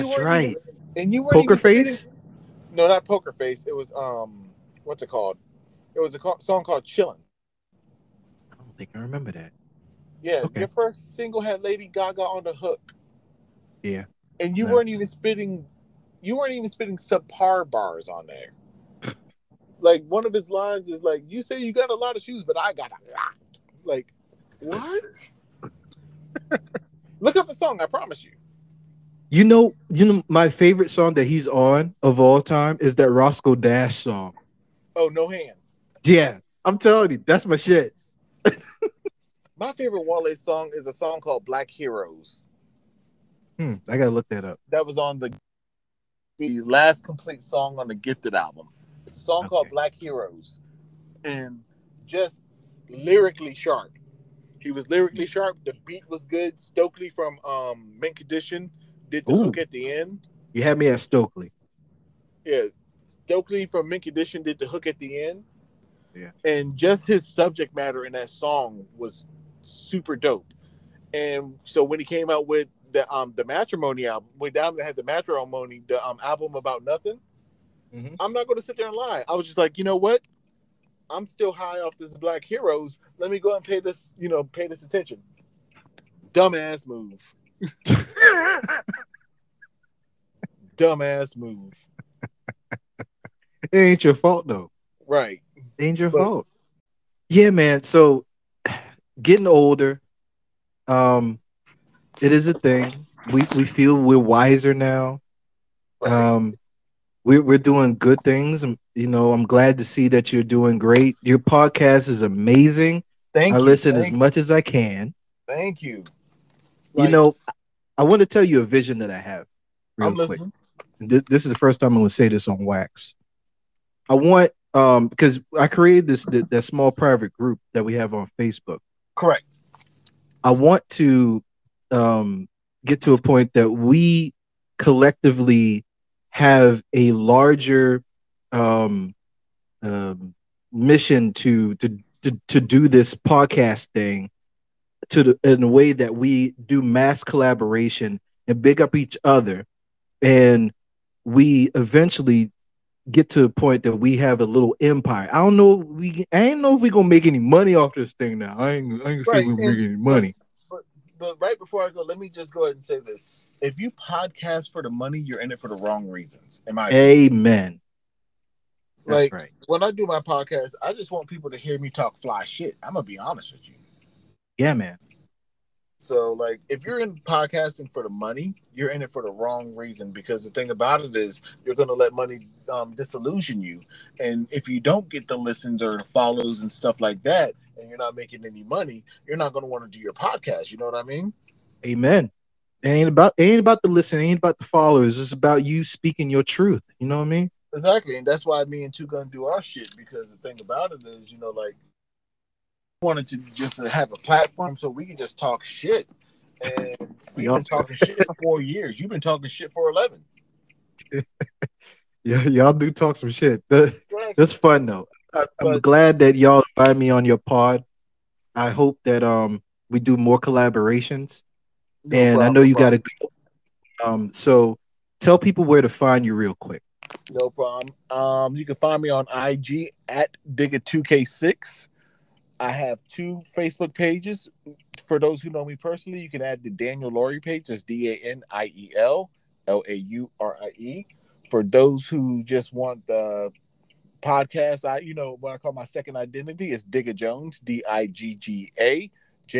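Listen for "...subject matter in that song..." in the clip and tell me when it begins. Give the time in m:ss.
1:07.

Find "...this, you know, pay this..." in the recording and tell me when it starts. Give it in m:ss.
1:23.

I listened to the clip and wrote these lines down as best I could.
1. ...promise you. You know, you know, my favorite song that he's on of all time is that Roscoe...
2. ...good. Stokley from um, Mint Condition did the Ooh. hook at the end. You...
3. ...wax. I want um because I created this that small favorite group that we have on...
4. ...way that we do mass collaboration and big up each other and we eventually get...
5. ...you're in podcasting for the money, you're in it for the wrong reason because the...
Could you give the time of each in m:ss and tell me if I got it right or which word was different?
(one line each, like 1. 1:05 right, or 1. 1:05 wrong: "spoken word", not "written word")
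1. 0:27 right
2. 0:56 right
3. 2:02 wrong: "private", not "favorite"
4. 2:25 right
5. 2:56 right.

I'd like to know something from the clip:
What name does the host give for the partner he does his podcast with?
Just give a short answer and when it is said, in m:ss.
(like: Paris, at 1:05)
2 Gun, at 3:18.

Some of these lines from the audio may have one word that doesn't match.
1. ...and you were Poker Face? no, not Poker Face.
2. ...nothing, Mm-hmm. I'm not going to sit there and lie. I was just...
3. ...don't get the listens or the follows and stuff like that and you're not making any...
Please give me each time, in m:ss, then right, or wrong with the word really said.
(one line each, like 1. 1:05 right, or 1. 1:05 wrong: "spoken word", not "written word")
1. 0:00 right
2. 1:16 right
3. 3:04 right.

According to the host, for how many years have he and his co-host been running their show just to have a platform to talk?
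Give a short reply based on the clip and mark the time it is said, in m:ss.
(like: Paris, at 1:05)
4 years, at 3:28.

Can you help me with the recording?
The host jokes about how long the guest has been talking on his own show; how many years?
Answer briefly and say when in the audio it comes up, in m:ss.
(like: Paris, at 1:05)
11, at 3:29.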